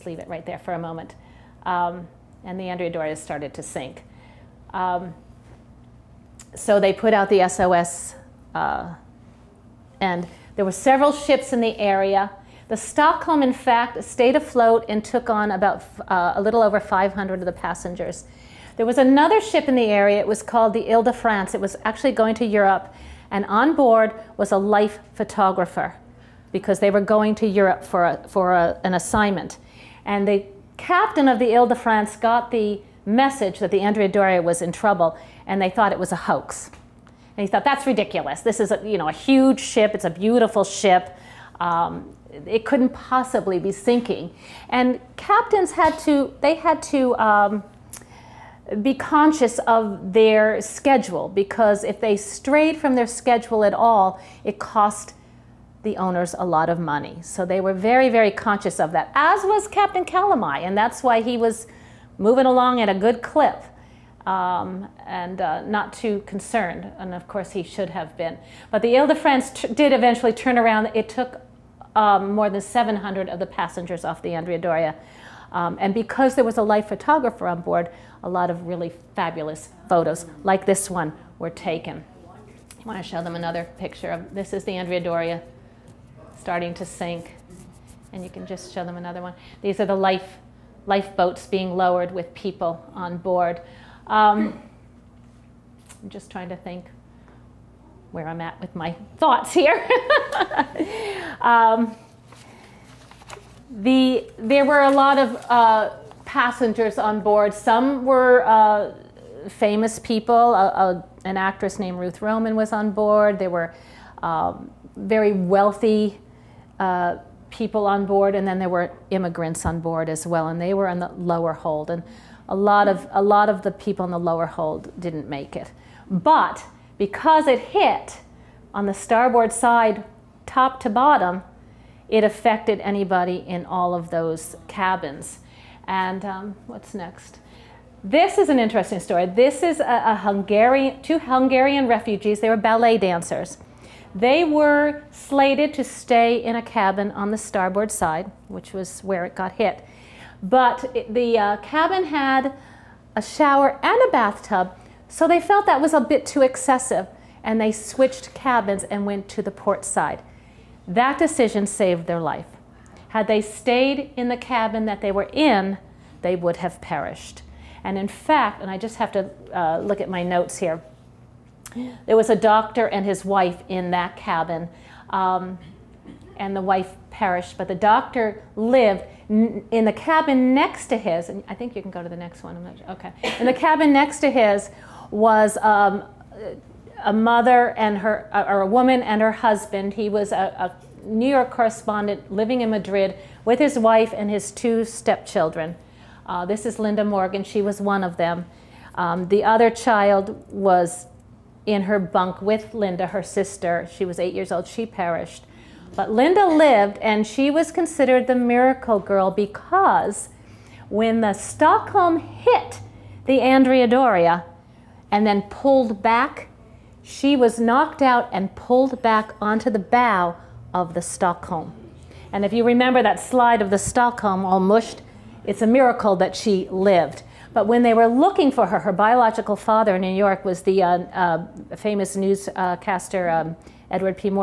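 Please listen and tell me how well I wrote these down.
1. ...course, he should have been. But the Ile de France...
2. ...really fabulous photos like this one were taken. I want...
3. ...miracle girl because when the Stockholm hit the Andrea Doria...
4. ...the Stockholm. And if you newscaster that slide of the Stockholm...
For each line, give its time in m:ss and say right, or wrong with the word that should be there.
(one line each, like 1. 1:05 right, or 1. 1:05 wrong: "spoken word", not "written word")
1. 1:07 right
2. 1:18 right
3. 3:28 right
4. 3:40 wrong: "remember", not "newscaster".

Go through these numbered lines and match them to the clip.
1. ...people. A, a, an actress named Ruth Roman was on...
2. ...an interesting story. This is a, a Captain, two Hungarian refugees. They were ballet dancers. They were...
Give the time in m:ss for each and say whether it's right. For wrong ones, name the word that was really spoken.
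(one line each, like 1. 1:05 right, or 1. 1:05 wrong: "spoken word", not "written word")
1. 1:49 right
2. 2:18 wrong: "Hungarian", not "Captain".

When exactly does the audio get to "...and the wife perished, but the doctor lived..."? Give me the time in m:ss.
2:56.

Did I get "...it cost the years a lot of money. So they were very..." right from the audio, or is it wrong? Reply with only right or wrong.
wrong.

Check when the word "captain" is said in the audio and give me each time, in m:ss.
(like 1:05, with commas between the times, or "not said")
0:30, 0:45, 0:59.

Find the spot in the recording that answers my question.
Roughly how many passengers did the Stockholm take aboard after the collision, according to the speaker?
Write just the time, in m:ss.
0:16.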